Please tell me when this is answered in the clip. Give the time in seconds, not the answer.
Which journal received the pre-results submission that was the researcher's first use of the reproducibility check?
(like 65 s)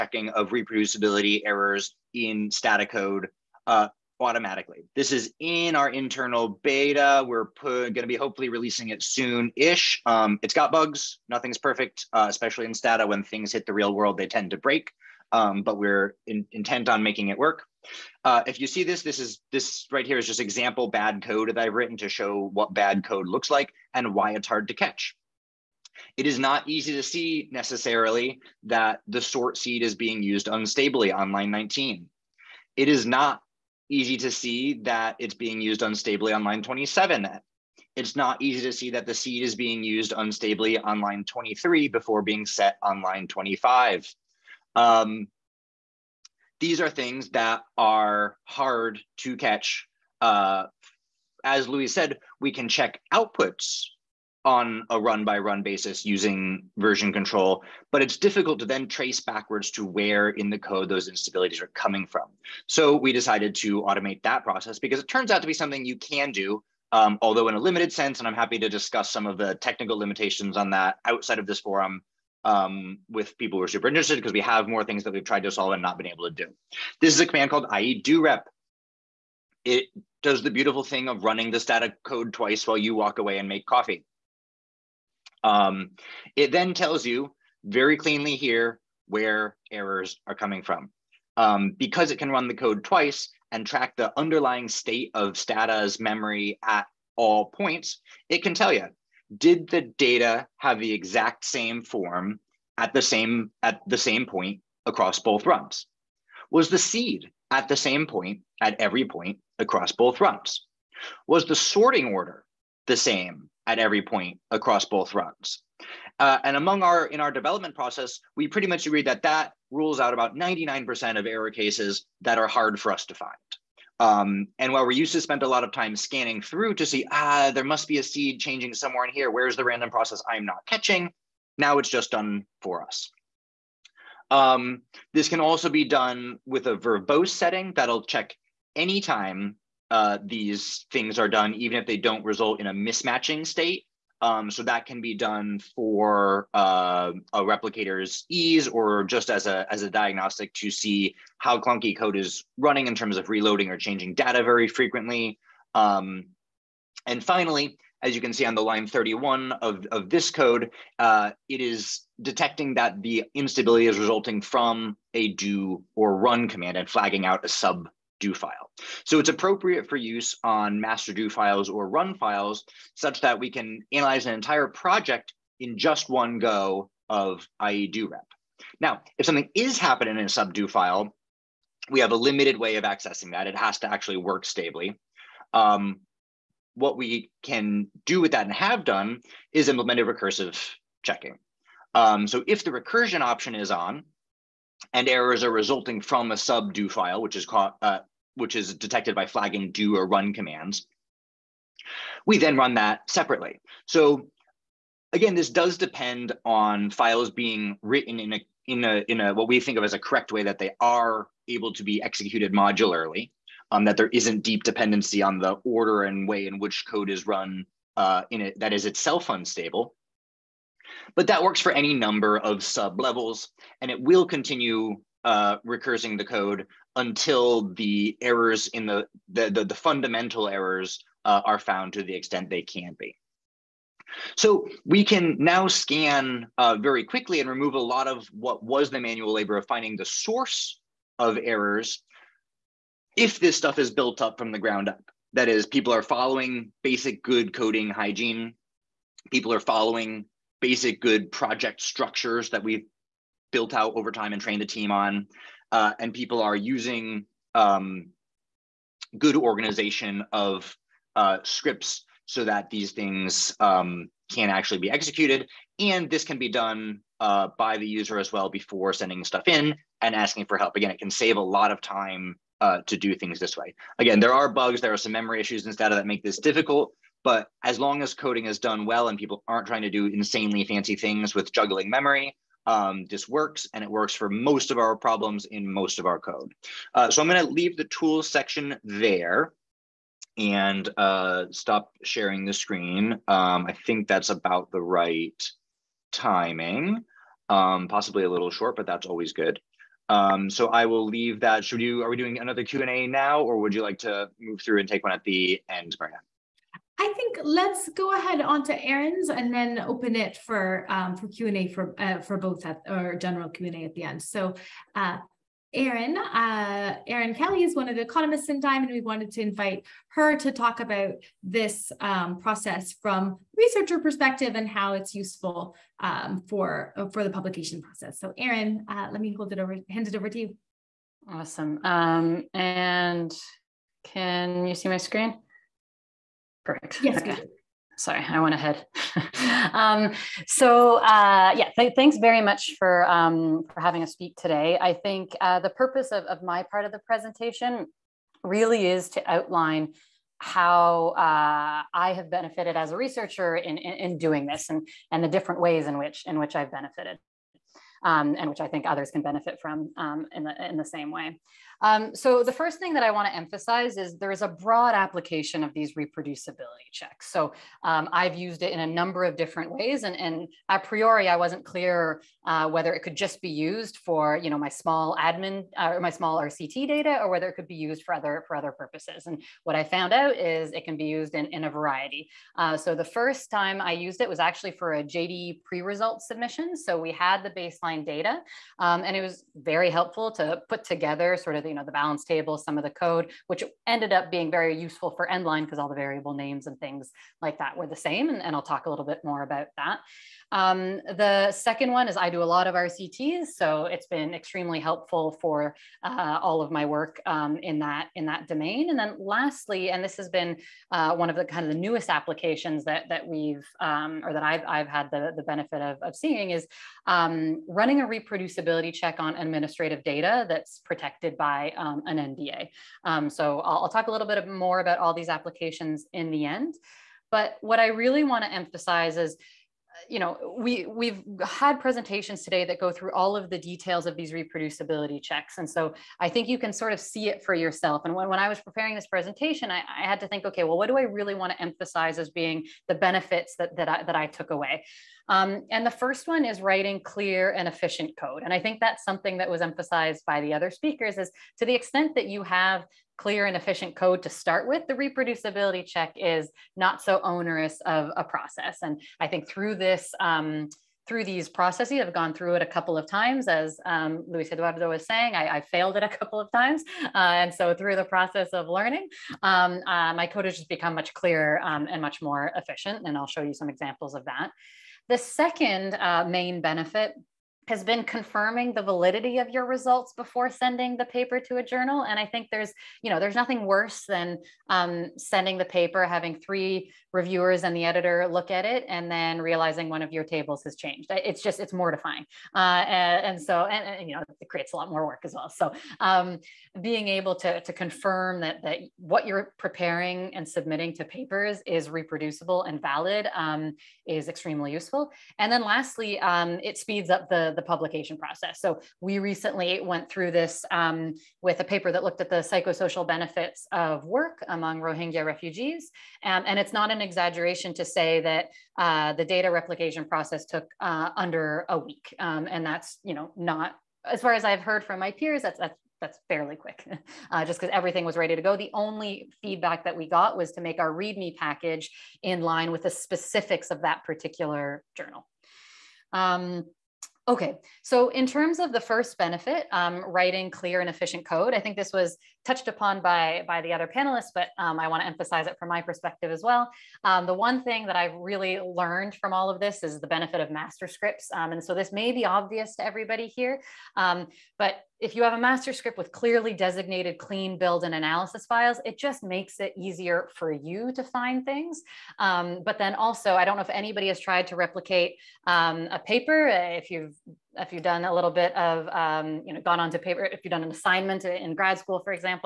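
385 s.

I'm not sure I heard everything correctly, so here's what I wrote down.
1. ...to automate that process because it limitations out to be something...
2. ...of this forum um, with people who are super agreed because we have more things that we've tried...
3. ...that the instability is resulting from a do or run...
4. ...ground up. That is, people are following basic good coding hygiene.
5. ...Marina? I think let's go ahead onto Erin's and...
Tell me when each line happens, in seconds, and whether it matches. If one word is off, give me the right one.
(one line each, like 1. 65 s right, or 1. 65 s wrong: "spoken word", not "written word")
1. 63 s wrong: "turns", not "limitations"
2. 71 s wrong: "interested", not "agreed"
3. 162 s right
4. 244 s right
5. 305 s right.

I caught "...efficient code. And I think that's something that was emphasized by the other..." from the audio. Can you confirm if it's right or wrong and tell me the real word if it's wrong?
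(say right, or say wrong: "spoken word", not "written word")
right.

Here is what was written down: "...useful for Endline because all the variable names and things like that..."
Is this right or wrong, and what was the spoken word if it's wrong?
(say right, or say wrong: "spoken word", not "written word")
right.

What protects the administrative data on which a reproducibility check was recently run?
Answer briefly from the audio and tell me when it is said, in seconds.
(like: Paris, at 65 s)
an NDA, at 422 s.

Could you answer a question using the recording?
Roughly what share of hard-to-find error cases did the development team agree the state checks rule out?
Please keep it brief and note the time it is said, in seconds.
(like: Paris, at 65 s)
99%, at 120 s.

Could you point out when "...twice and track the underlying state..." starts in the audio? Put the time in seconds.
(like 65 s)
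92 s.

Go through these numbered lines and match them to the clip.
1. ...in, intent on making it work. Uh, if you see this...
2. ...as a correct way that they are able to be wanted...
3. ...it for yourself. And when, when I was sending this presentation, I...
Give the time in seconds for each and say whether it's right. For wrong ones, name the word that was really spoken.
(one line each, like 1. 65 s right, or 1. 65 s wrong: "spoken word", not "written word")
1. 16 s right
2. 209 s wrong: "executed", not "wanted"
3. 437 s wrong: "preparing", not "sending".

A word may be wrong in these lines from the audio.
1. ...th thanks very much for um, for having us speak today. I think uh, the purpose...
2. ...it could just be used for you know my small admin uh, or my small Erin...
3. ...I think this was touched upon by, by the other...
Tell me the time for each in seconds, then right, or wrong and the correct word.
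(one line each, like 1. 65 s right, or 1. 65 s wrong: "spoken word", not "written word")
1. 341 s right
2. 372 s wrong: "RCT", not "Erin"
3. 541 s right.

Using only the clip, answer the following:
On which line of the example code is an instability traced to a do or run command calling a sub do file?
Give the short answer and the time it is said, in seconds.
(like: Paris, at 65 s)
31, at 158 s.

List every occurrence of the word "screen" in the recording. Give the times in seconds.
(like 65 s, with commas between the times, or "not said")
292 s, 334 s.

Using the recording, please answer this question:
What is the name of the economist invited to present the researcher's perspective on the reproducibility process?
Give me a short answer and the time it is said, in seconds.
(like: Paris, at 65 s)
Erin Kelley, at 317 s.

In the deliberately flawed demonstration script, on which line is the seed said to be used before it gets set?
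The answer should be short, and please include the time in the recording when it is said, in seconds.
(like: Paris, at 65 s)
23, at 40 s.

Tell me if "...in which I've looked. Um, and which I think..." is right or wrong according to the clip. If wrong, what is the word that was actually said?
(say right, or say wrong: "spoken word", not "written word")
wrong: "benefited", not "looked".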